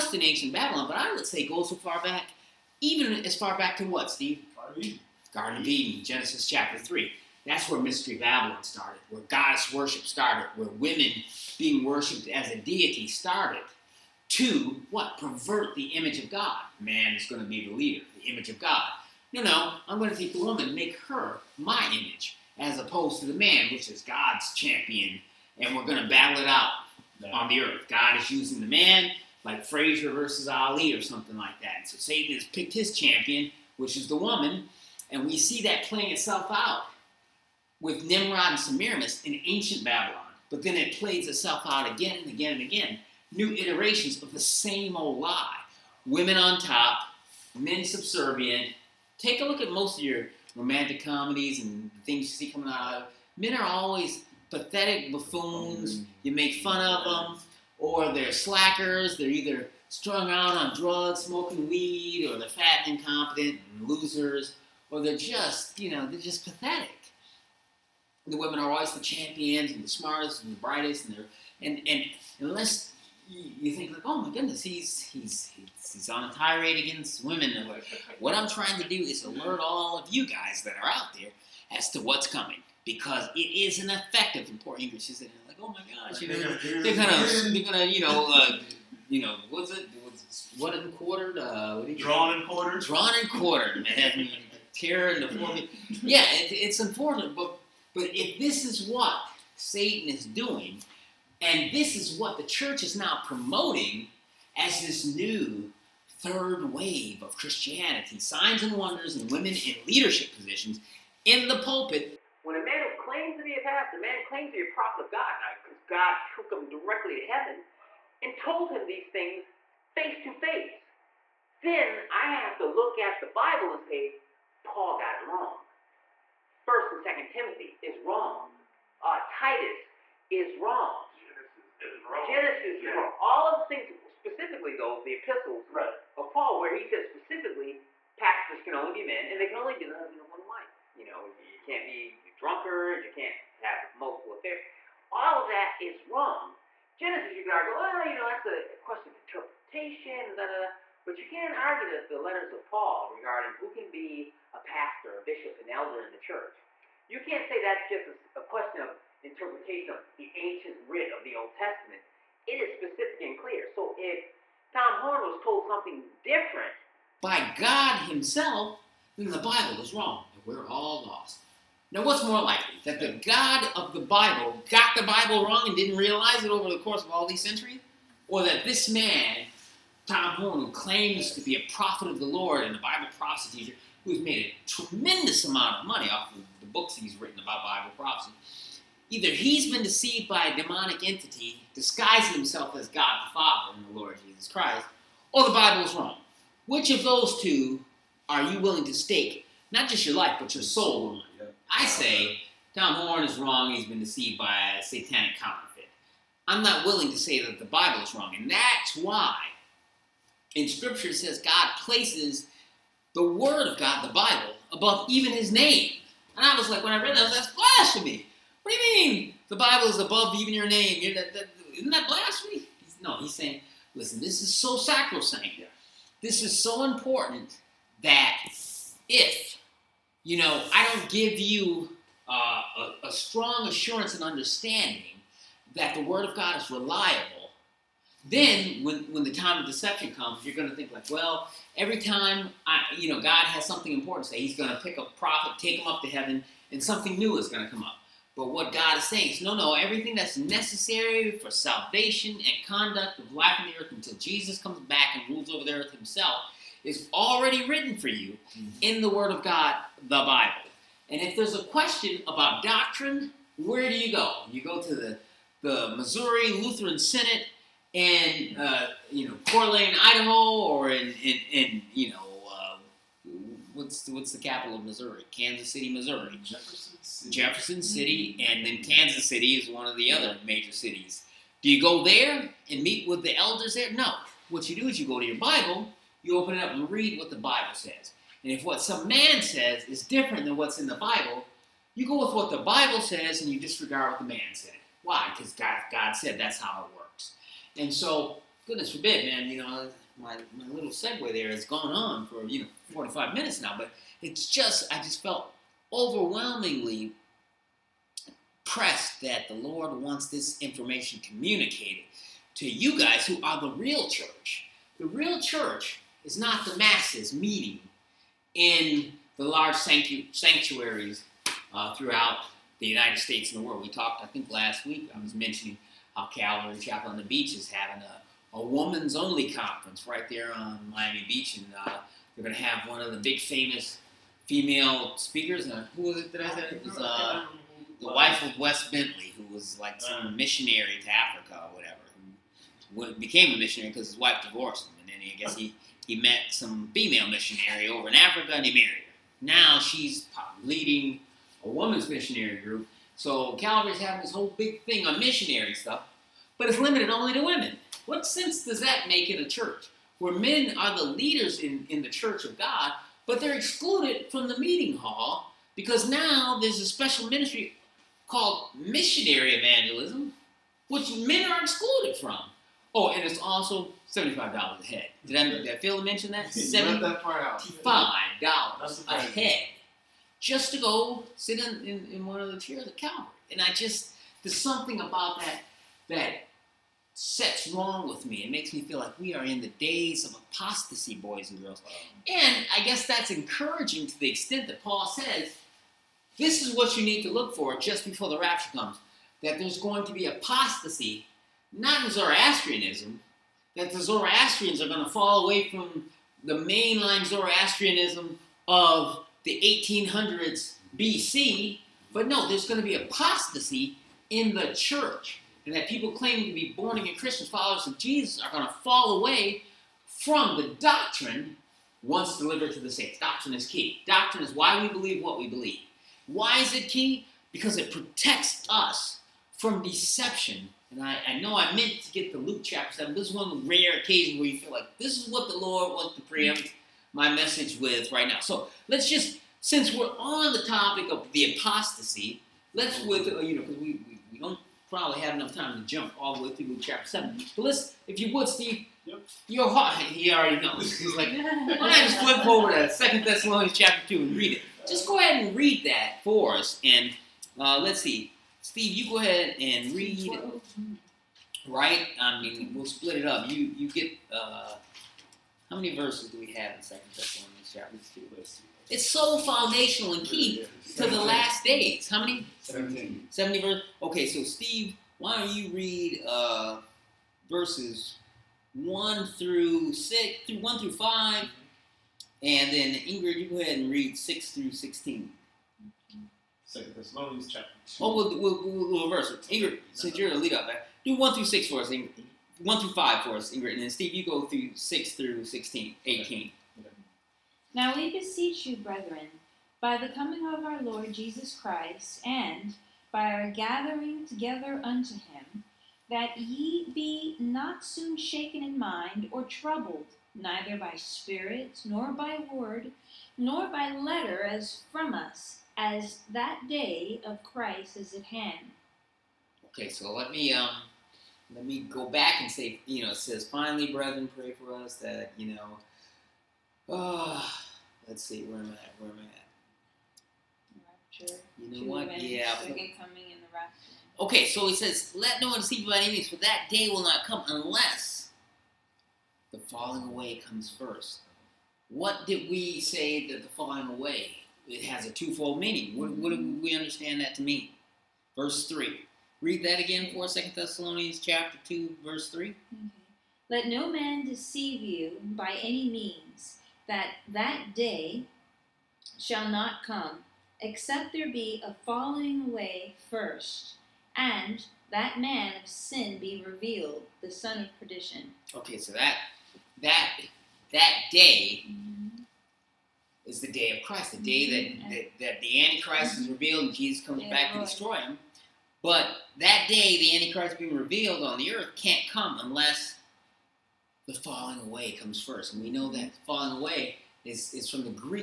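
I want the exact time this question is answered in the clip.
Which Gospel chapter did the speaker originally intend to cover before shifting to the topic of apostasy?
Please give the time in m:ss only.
7:12.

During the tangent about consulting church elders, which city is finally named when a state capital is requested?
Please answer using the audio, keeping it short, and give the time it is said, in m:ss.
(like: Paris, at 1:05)
Jefferson City, at 4:37.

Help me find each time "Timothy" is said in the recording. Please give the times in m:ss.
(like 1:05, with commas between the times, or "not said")
2:07.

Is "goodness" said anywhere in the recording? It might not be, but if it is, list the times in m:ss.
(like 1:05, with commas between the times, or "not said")
1:14, 4:58.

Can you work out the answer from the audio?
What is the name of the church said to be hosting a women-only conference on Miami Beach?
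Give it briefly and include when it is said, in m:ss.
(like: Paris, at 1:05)
Calvary Chapel on the Beach, at 5:26.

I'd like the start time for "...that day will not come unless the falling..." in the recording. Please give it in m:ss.
8:56.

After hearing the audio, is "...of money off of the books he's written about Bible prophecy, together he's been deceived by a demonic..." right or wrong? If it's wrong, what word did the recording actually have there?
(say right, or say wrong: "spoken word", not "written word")
wrong: "either", not "together".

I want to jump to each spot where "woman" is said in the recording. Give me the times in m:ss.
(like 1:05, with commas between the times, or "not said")
0:20, 0:34, 5:28, 5:51.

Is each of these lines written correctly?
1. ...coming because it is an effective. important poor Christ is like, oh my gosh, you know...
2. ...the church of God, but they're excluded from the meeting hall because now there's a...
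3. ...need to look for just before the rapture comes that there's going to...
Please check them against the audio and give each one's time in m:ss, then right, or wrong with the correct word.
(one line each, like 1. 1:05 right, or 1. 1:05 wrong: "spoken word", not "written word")
1. 1:22 wrong: "English", not "Christ"
2. 6:02 right
3. 6:37 right.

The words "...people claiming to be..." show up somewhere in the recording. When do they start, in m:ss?
6:55.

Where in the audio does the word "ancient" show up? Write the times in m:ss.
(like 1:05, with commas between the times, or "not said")
0:00, 0:39, 2:40.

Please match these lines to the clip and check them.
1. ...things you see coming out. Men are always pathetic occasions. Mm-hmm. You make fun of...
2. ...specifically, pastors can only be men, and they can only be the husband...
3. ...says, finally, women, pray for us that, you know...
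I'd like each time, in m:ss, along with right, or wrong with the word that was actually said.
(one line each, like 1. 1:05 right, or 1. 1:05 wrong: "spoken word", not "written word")
1. 0:52 wrong: "buffoons", not "occasions"
2. 2:17 right
3. 8:43 wrong: "brethren", not "women".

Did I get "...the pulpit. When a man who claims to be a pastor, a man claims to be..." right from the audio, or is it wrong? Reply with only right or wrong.
right.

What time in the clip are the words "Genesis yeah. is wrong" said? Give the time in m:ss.
2:12.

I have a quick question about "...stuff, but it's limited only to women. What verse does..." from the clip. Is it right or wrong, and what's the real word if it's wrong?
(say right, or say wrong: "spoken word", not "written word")
wrong: "sense", not "verse".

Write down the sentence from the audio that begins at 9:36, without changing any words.
is revealed and Jesus comes yeah, back to destroy him.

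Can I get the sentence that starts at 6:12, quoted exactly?
Oh, and it's also seventy-five dollars a head.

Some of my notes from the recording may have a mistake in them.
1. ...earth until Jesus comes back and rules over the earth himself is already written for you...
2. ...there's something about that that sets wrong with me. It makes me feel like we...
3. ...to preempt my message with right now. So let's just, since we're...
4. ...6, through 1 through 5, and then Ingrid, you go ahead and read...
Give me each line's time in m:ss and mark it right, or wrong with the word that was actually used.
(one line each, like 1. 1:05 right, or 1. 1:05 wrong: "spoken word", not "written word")
1. 4:13 right
2. 6:24 right
3. 7:16 right
4. 7:59 right.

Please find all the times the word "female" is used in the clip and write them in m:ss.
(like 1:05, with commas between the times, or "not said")
5:34, 5:46.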